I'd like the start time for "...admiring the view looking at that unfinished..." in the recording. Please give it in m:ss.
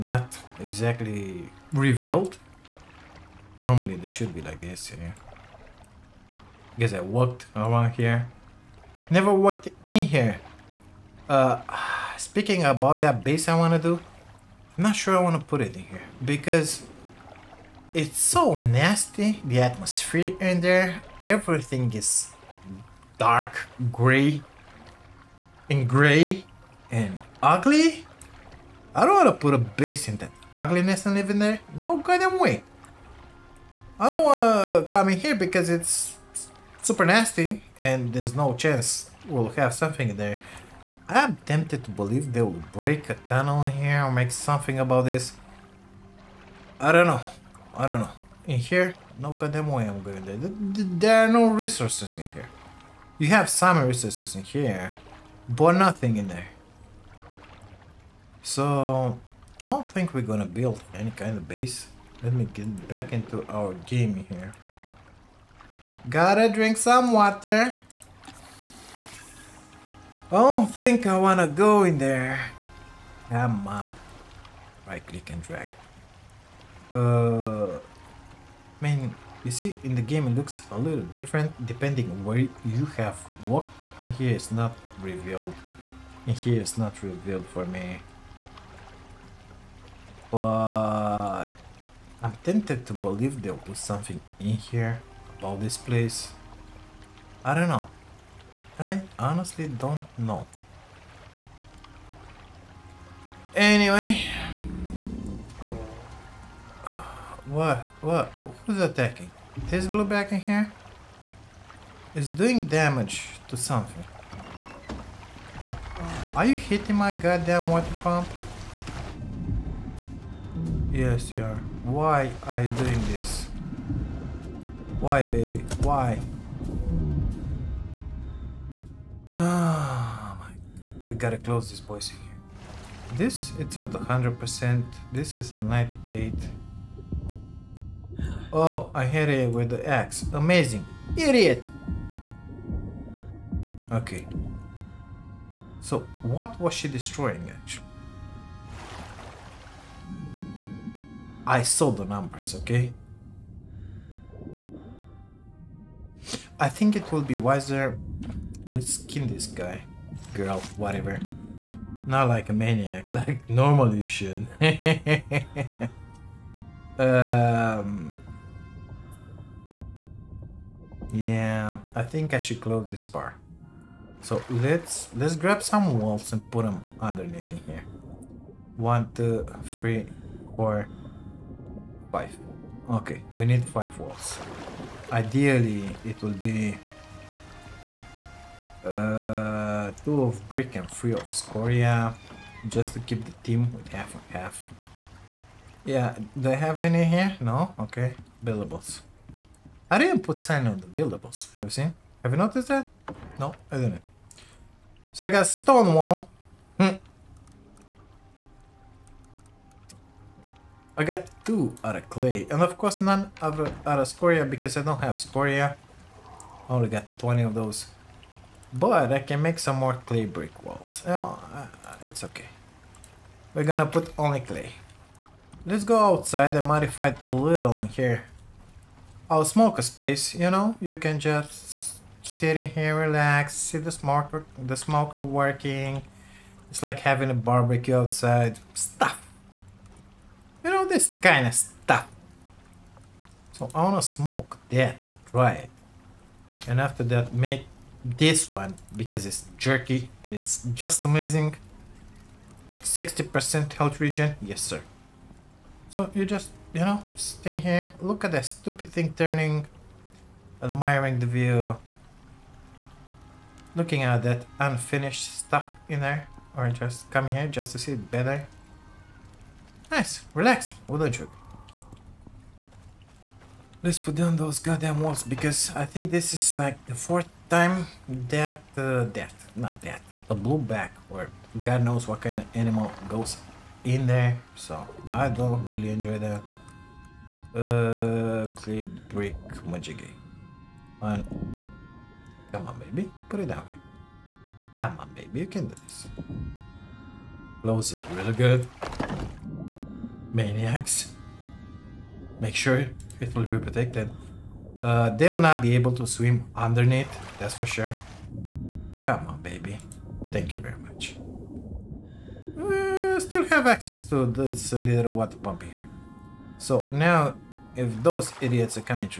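4:20.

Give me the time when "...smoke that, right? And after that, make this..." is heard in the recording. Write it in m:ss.
4:04.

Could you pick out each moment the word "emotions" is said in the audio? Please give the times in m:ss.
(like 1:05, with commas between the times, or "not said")
not said.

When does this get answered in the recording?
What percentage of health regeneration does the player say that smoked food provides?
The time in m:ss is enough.
4:12.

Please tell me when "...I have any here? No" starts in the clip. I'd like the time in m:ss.
3:16.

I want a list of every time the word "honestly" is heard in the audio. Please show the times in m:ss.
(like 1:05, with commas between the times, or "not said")
1:39.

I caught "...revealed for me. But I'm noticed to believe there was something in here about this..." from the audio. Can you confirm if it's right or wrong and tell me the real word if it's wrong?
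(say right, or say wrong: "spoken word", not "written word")
wrong: "tempted", not "noticed".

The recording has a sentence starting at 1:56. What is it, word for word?
Are you hitting my goddamn water pump?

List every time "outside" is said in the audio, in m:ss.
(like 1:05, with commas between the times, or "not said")
3:45, 3:57.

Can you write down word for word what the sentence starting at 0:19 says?
The atmosphere in there, everything is dark gray and gray and ugly.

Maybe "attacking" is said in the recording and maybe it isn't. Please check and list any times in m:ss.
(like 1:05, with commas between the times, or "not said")
1:48.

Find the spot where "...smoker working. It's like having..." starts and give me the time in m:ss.
3:54.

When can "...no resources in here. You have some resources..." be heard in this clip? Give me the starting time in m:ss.
0:51.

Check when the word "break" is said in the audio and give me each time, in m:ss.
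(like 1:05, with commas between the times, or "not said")
0:42.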